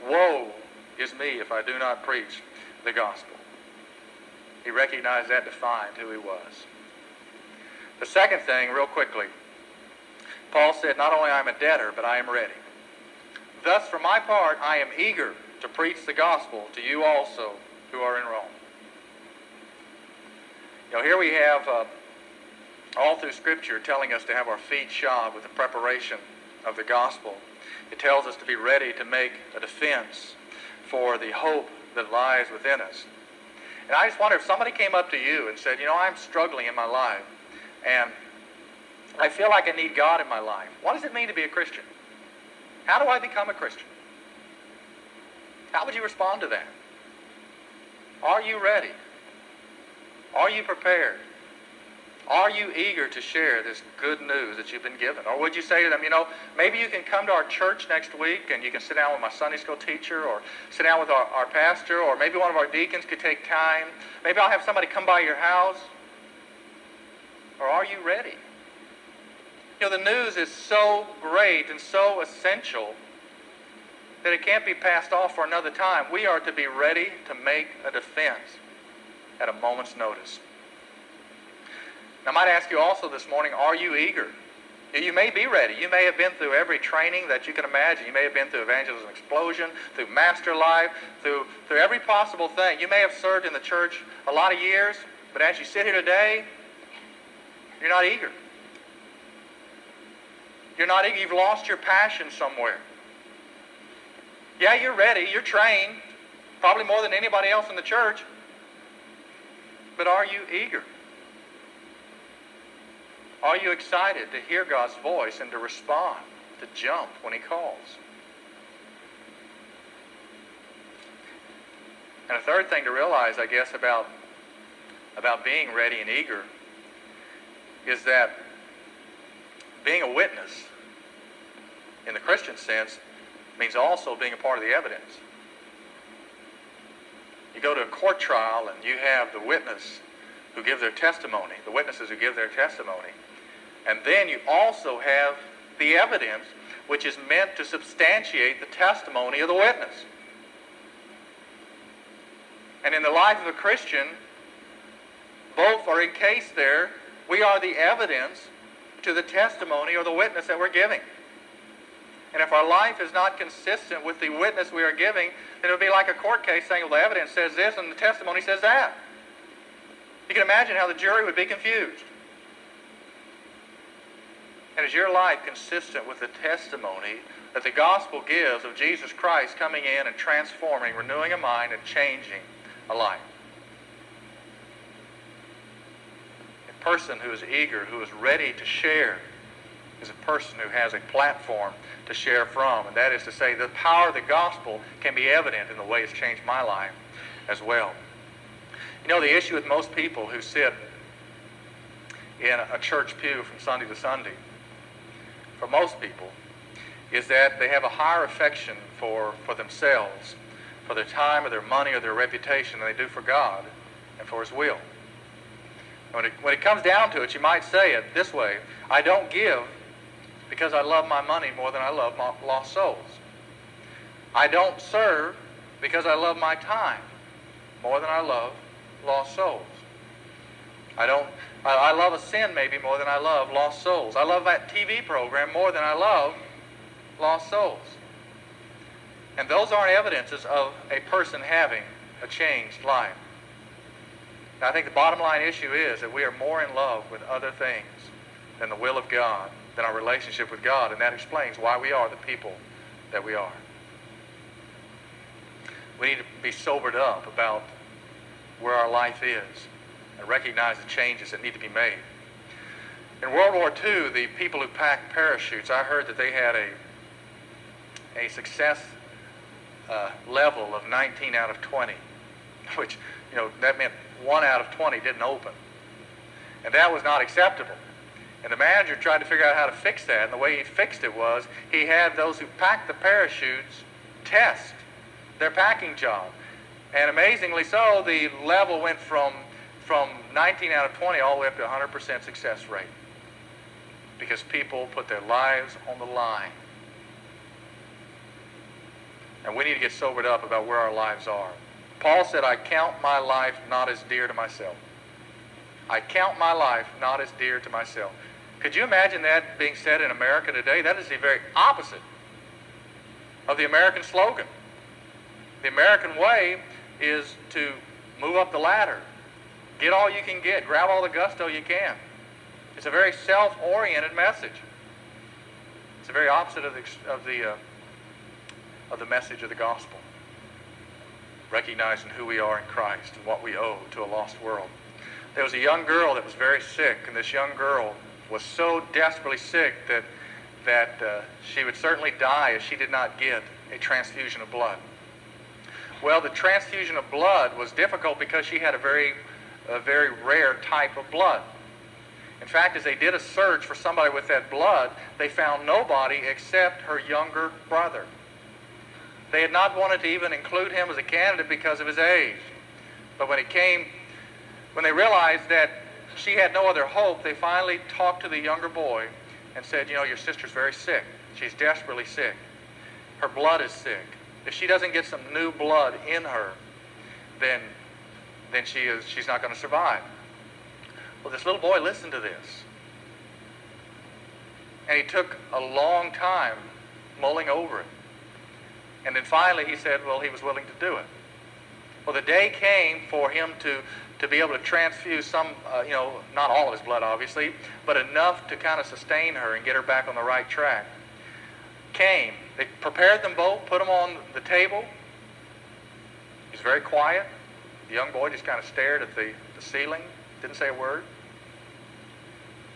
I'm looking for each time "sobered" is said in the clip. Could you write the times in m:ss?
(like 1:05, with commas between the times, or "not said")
4:16, 4:59.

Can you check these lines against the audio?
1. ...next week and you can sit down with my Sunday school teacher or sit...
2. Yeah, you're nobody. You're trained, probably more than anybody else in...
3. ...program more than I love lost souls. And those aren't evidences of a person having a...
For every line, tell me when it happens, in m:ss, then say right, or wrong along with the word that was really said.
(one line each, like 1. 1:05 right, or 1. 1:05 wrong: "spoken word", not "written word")
1. 0:57 right
2. 1:44 wrong: "ready", not "nobody"
3. 3:55 right.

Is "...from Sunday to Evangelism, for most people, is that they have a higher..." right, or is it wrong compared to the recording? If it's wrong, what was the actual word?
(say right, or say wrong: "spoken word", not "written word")
wrong: "Sunday", not "Evangelism".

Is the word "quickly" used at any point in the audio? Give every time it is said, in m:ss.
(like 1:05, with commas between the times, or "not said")
0:08.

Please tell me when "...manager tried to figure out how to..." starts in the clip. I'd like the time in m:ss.
4:38.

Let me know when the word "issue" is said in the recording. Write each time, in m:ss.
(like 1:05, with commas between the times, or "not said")
3:19, 4:05.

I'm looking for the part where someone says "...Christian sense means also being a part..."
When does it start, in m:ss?
2:12.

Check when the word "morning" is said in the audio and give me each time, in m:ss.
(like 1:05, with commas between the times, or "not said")
1:23.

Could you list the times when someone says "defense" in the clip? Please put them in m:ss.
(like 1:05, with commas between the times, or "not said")
0:29, 1:17.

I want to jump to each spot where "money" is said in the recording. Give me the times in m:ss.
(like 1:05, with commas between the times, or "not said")
3:31, 3:41.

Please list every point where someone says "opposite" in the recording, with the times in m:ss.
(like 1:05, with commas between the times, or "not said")
5:11, 5:26.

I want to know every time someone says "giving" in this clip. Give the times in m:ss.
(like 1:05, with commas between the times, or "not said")
2:40, 2:44.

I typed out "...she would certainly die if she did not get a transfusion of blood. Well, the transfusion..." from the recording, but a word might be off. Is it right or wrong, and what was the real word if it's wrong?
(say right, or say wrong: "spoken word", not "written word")
right.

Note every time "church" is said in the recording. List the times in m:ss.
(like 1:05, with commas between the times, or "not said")
0:57, 1:33, 1:47, 3:22.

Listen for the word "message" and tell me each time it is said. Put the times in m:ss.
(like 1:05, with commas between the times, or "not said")
5:24, 5:29.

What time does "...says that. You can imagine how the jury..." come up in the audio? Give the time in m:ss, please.
2:48.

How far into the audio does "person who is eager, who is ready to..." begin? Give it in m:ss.
3:06.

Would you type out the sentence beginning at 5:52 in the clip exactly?
In fact, as they did a search for somebody with that blood, they found nobody except her younger brother.